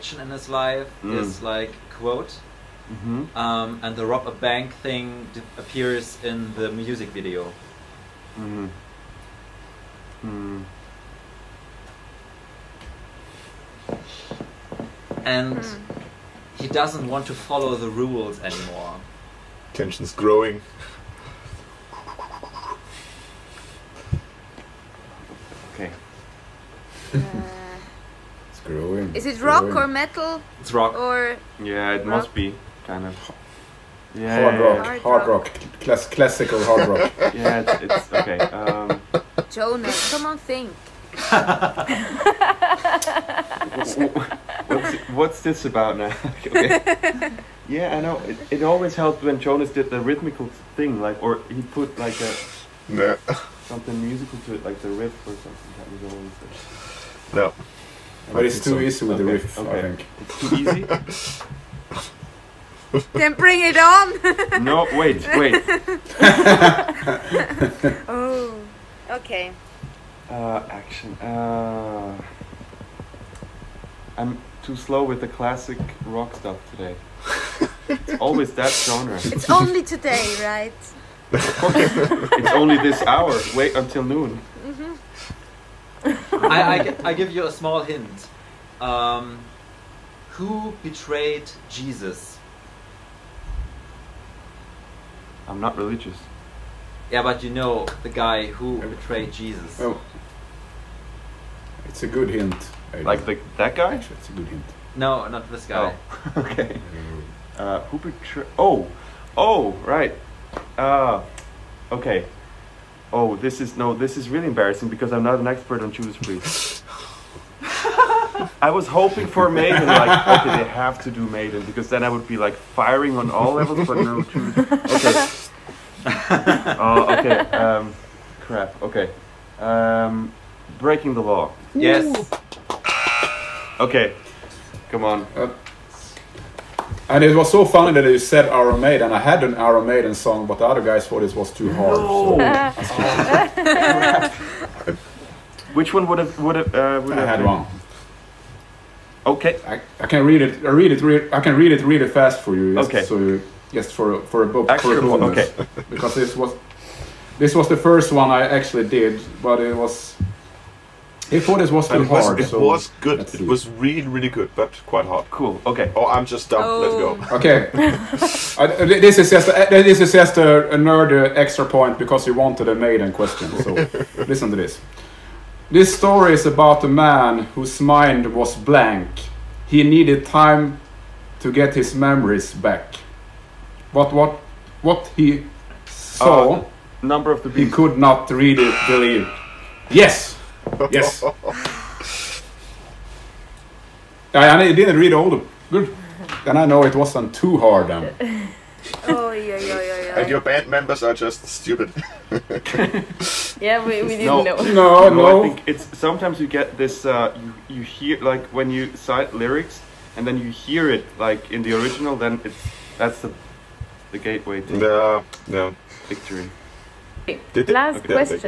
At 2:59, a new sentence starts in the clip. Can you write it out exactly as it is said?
He needed time to get his memories back.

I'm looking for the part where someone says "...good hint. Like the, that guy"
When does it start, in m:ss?
1:42.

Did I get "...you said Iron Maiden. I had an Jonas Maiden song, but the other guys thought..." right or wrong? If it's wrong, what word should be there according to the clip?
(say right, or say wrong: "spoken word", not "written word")
wrong: "Iron", not "Jonas".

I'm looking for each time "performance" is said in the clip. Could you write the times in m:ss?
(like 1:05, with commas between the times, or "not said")
not said.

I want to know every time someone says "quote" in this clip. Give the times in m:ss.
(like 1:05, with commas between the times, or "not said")
0:01.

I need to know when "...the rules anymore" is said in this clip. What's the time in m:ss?
0:17.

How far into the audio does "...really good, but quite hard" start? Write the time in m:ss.
2:44.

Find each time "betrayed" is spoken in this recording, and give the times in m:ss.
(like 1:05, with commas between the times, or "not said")
1:30, 1:38, 1:47.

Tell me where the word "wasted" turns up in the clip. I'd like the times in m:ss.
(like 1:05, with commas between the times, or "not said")
not said.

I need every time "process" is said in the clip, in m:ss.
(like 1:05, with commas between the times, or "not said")
not said.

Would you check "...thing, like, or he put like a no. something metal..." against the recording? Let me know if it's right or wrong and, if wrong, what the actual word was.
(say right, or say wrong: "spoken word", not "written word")
wrong: "musical", not "metal".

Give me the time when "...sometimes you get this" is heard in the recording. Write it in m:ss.
3:25.